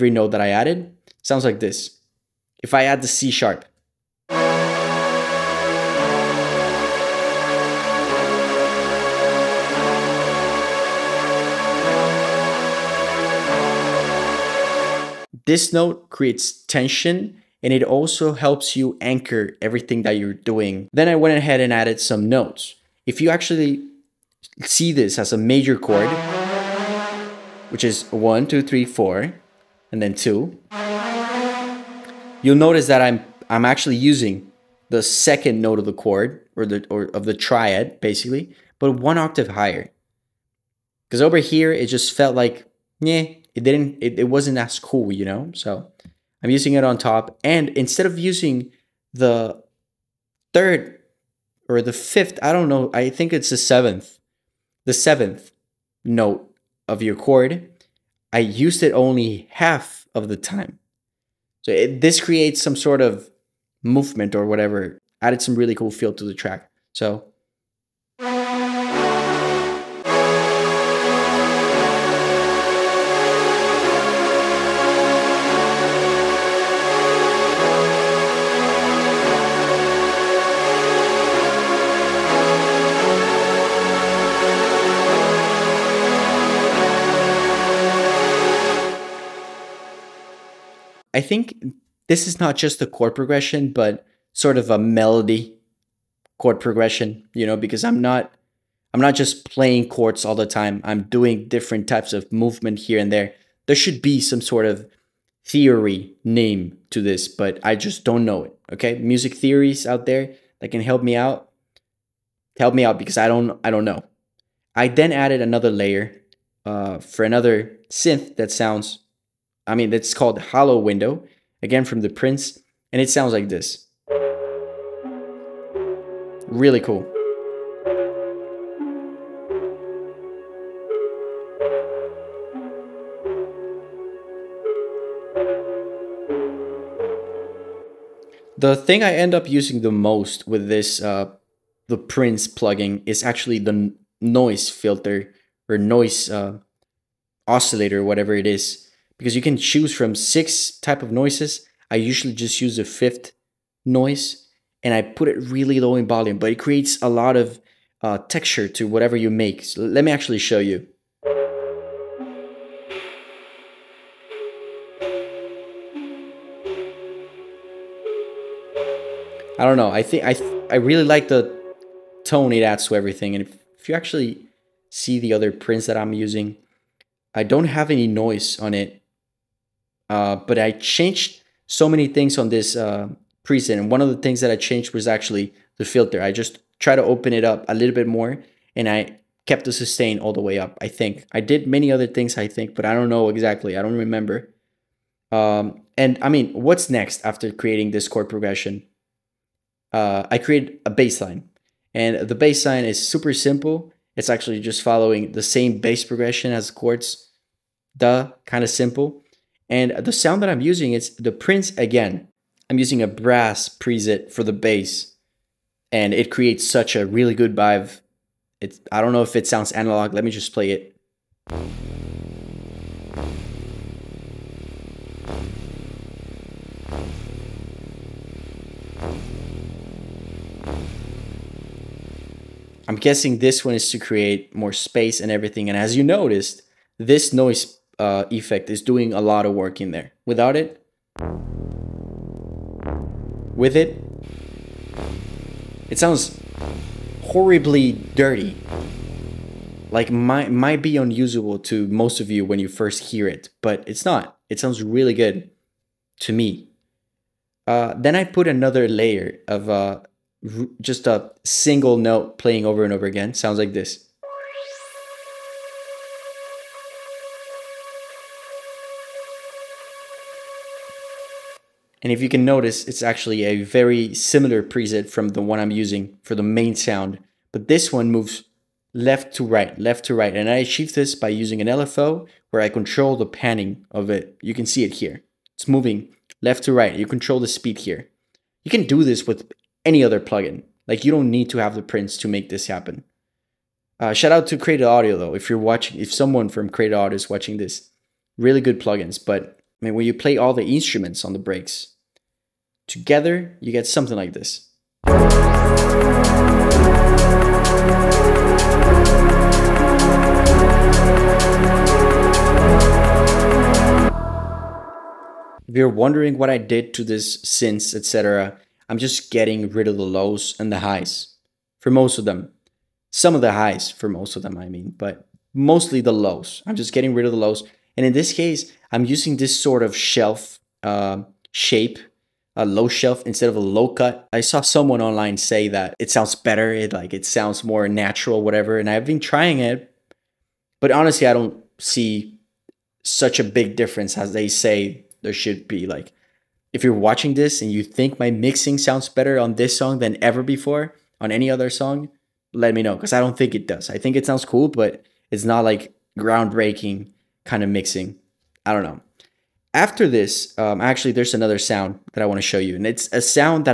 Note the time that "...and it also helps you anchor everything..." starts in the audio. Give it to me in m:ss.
0:17.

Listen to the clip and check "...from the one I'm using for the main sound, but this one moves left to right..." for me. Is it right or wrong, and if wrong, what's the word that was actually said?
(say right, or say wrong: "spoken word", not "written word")
right.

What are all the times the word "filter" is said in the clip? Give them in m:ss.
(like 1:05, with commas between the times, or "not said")
2:24, 3:05.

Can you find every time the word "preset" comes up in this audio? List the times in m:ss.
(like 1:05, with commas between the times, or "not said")
3:03, 3:33, 4:34.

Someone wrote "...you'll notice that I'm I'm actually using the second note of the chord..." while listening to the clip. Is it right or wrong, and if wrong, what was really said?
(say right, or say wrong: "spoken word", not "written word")
right.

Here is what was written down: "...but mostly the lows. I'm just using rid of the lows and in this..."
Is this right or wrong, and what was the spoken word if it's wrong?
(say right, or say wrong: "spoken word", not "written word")
wrong: "getting", not "using".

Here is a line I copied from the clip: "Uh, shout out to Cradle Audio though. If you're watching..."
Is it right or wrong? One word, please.
right.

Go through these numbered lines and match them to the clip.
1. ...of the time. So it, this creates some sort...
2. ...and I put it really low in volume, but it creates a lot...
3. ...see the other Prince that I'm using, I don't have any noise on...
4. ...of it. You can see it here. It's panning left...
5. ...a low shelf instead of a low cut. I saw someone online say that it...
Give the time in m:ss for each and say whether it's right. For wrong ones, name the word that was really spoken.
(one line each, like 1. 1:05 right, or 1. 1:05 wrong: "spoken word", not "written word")
1. 1:00 right
2. 2:34 right
3. 2:54 right
4. 4:43 wrong: "moving", not "panning"
5. 5:32 right.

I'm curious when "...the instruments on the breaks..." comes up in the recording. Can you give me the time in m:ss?
5:00.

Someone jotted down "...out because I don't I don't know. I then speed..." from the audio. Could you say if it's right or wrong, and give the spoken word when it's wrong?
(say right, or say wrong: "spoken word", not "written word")
wrong: "added", not "speed".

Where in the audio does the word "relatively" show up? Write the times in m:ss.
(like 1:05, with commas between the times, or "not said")
not said.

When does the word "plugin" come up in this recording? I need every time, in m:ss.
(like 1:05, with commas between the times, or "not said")
2:22, 4:50, 4:58.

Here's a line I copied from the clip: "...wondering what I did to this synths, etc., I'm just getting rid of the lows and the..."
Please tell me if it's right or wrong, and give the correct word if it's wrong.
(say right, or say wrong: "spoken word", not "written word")
right.